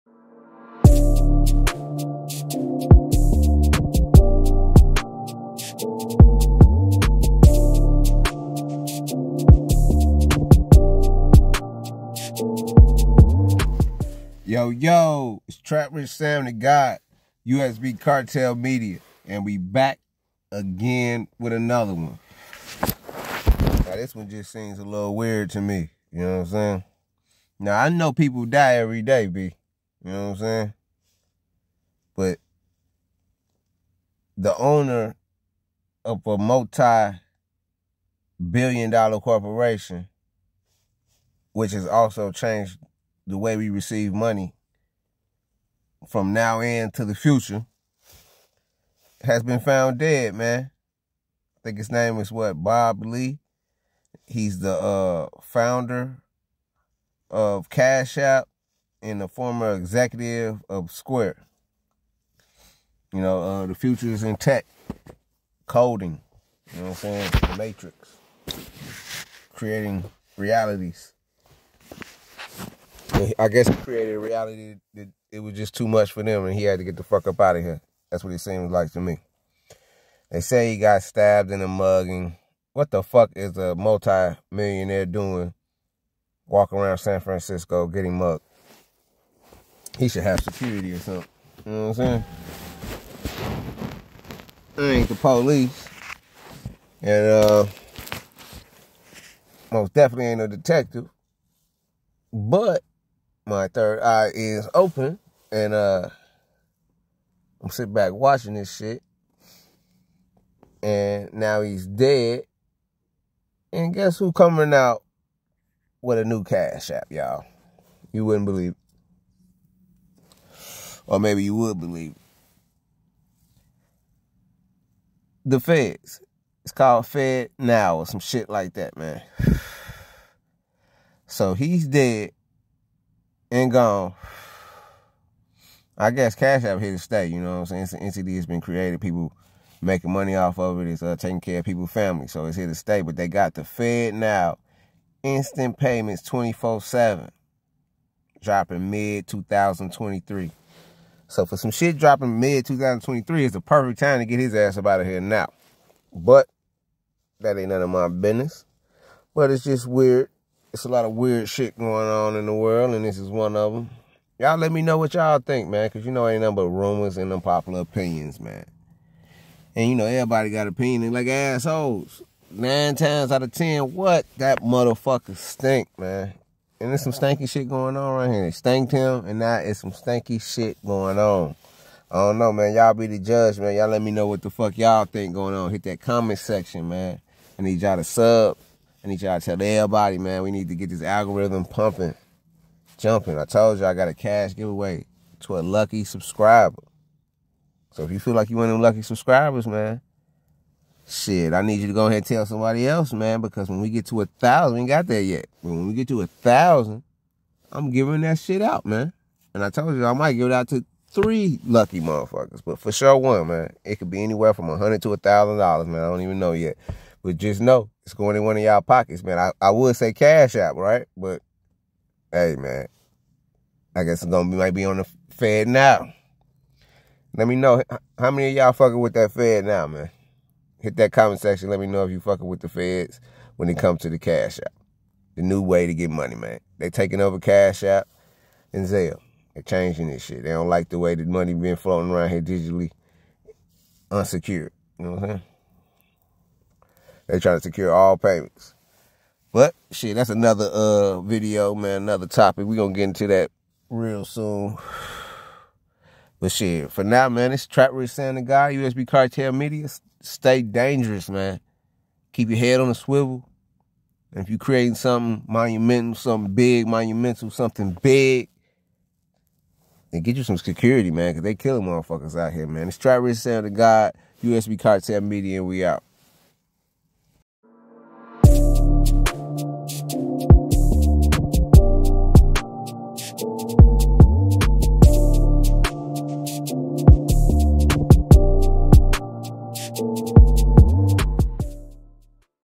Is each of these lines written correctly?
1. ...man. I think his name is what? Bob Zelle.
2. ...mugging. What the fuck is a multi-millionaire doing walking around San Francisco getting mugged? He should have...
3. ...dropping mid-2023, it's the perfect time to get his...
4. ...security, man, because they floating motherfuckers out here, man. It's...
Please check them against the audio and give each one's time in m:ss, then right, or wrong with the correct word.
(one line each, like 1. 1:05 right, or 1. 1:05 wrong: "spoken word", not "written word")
1. 0:50 wrong: "Lee", not "Zelle"
2. 1:21 right
3. 2:31 right
4. 4:30 wrong: "killing", not "floating".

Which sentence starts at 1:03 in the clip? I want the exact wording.
You know, uh, the future is in tech, coding, you know what I'm saying?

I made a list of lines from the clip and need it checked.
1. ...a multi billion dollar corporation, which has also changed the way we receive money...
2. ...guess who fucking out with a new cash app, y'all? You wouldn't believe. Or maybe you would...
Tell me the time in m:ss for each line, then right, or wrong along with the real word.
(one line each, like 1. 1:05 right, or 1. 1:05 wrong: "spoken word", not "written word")
1. 0:36 right
2. 1:53 wrong: "coming", not "fucking".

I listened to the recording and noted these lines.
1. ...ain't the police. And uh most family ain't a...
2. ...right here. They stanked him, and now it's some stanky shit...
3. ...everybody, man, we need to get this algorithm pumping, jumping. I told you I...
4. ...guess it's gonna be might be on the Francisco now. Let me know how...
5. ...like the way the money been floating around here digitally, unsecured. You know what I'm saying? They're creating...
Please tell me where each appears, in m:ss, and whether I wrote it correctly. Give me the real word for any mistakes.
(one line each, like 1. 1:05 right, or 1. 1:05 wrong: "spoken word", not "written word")
1. 1:34 wrong: "definitely", not "family"
2. 2:58 right
3. 3:09 right
4. 3:44 wrong: "Fed", not "Francisco"
5. 4:00 wrong: "trying", not "creating".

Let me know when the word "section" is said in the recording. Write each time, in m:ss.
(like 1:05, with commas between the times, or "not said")
3:06, 3:51.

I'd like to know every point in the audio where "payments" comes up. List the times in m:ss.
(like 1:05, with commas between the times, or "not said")
2:25, 4:08.